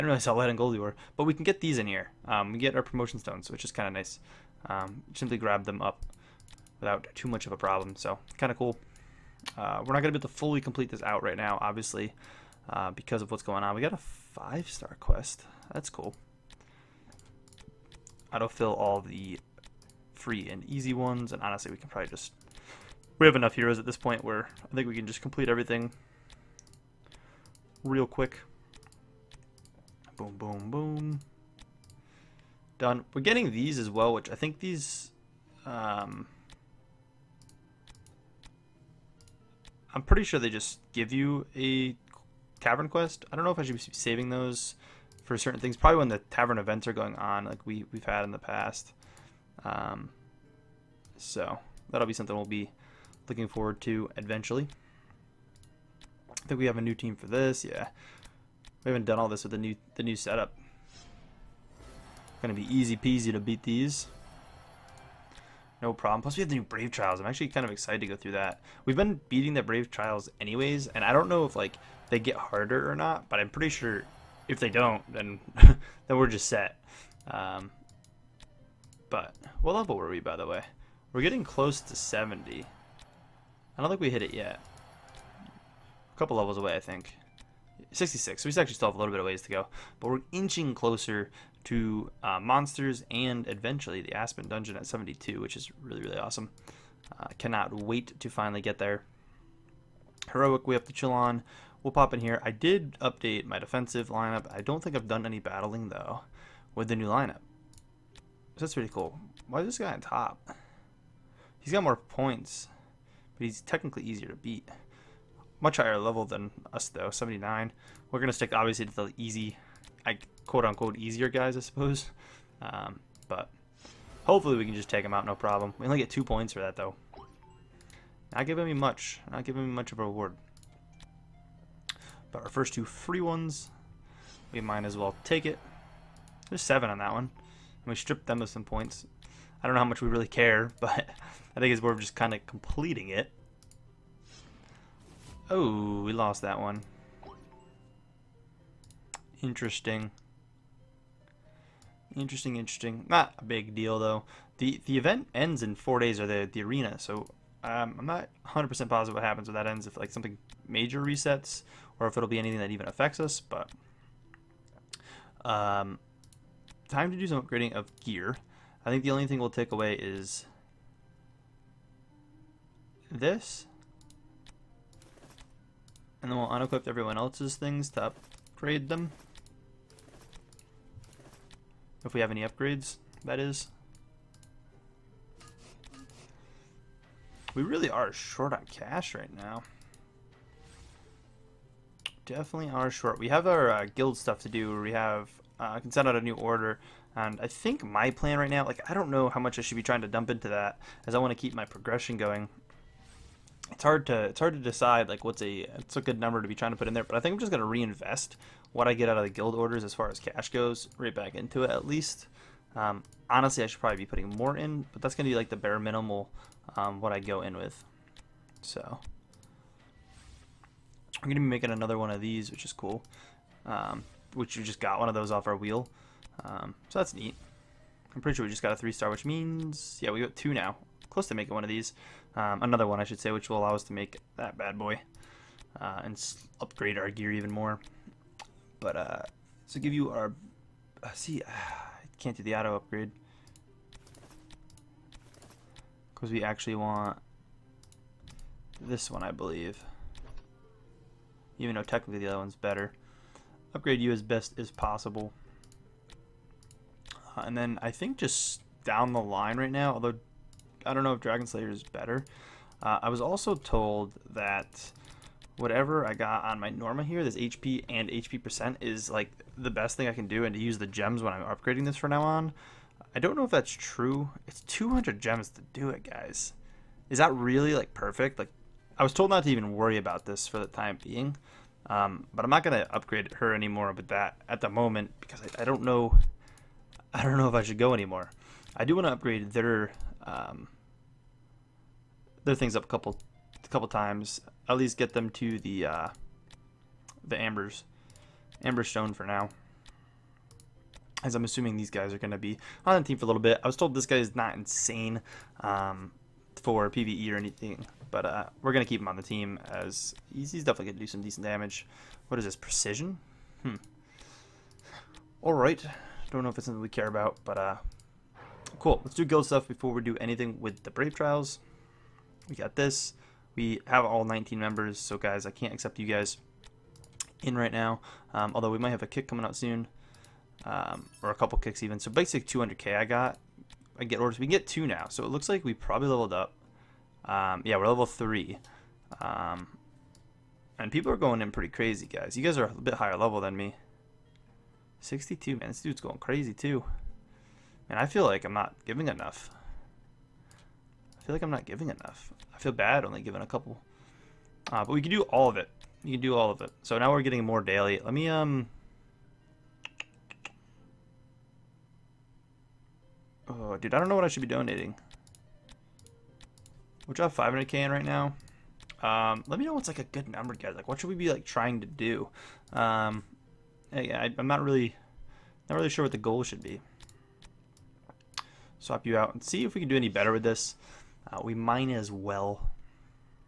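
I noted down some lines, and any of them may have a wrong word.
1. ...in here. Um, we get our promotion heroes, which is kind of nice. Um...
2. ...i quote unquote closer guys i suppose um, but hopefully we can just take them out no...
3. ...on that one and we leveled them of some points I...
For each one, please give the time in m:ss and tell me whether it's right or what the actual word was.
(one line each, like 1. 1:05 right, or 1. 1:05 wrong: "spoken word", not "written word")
1. 0:01 wrong: "stones", not "heroes"
2. 2:00 wrong: "easier", not "closer"
3. 2:16 wrong: "stripped", not "leveled".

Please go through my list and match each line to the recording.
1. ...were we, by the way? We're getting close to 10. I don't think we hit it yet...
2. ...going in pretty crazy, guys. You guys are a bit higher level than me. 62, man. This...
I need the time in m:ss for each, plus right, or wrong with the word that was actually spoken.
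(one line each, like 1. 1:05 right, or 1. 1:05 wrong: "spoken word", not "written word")
1. 1:19 wrong: "70", not "10"
2. 5:41 right.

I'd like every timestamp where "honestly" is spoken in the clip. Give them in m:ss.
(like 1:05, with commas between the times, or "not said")
0:21, 3:33.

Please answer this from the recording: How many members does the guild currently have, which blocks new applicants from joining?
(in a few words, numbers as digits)
19.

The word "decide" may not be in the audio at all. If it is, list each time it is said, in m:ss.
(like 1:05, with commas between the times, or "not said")
3:24.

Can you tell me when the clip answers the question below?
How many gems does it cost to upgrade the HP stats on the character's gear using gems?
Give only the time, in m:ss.
4:34.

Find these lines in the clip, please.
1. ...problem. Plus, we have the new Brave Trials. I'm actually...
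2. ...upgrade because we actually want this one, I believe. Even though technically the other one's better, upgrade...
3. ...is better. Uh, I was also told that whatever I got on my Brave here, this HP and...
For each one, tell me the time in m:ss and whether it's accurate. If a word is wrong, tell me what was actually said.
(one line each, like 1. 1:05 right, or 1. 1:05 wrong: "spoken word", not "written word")
1. 1:05 right
2. 4:02 right
3. 4:21 wrong: "Norma", not "Brave".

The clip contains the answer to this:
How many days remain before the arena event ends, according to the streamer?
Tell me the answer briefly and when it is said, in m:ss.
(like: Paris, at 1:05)
4, at 2:35.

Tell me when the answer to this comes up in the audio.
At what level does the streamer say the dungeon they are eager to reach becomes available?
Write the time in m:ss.
1:34.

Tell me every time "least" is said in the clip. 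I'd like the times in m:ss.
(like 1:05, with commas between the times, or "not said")
3:31, 4:54.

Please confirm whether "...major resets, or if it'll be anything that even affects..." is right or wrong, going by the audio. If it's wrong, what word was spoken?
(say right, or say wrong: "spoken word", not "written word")
right.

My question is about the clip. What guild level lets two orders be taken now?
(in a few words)
3.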